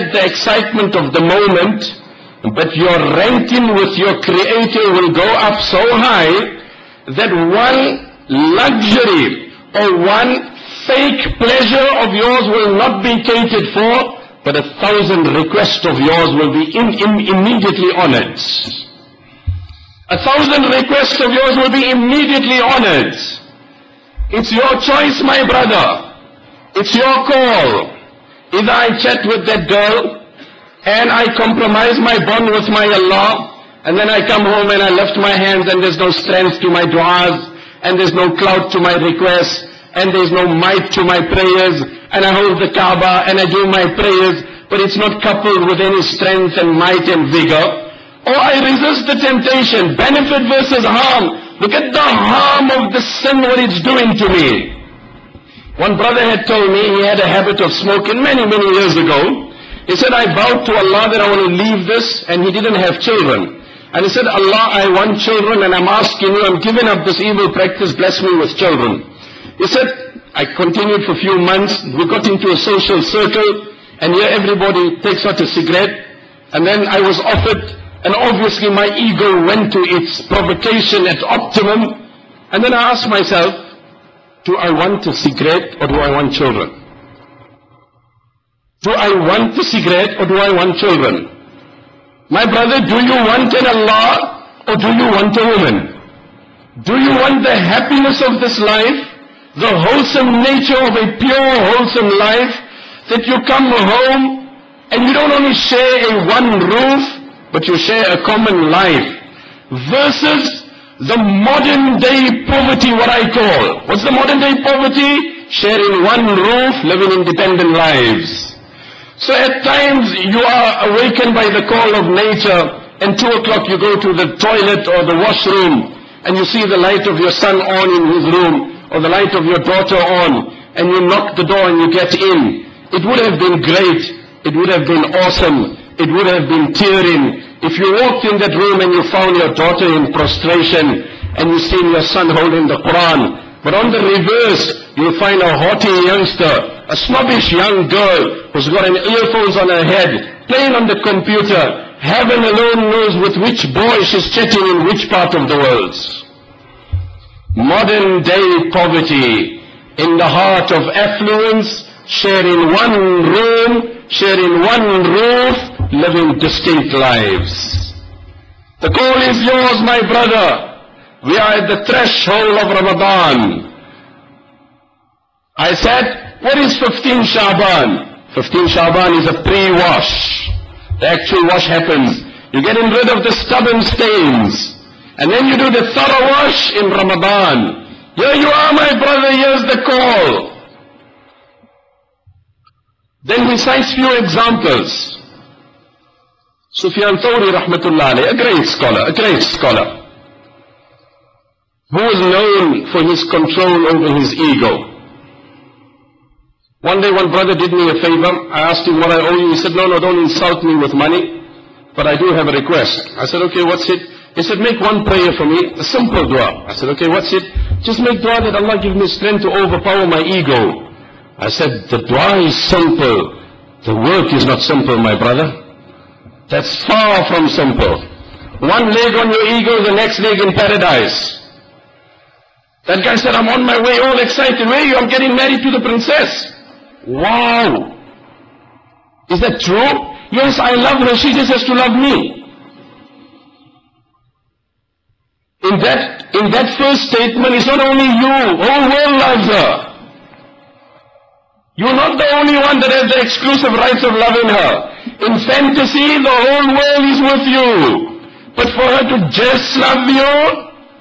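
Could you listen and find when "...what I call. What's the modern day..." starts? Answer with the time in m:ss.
1:52.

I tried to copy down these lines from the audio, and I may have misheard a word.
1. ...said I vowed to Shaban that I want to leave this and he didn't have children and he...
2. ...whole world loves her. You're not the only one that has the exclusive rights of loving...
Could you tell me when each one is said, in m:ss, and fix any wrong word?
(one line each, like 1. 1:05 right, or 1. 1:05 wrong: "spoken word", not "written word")
1. 0:59 wrong: "Allah", not "Shaban"
2. 4:08 right.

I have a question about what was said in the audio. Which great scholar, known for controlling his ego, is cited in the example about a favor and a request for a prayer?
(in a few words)
Sufyan Thawri.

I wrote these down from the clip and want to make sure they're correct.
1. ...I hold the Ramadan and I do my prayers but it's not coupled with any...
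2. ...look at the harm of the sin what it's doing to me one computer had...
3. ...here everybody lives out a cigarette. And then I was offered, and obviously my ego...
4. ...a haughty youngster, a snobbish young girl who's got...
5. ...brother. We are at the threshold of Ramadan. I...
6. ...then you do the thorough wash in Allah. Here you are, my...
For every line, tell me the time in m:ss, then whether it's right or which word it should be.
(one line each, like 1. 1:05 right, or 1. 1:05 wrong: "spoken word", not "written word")
1. 0:42 wrong: "Kaaba", not "Ramadan"
2. 0:51 wrong: "brother", not "computer"
3. 1:14 wrong: "takes", not "lives"
4. 2:25 right
5. 2:50 right
6. 3:05 wrong: "Ramadan", not "Allah".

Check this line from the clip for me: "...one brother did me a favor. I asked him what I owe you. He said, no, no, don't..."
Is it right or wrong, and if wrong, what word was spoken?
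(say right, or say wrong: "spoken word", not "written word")
right.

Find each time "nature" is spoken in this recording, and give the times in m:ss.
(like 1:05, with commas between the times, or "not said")
1:40, 2:02.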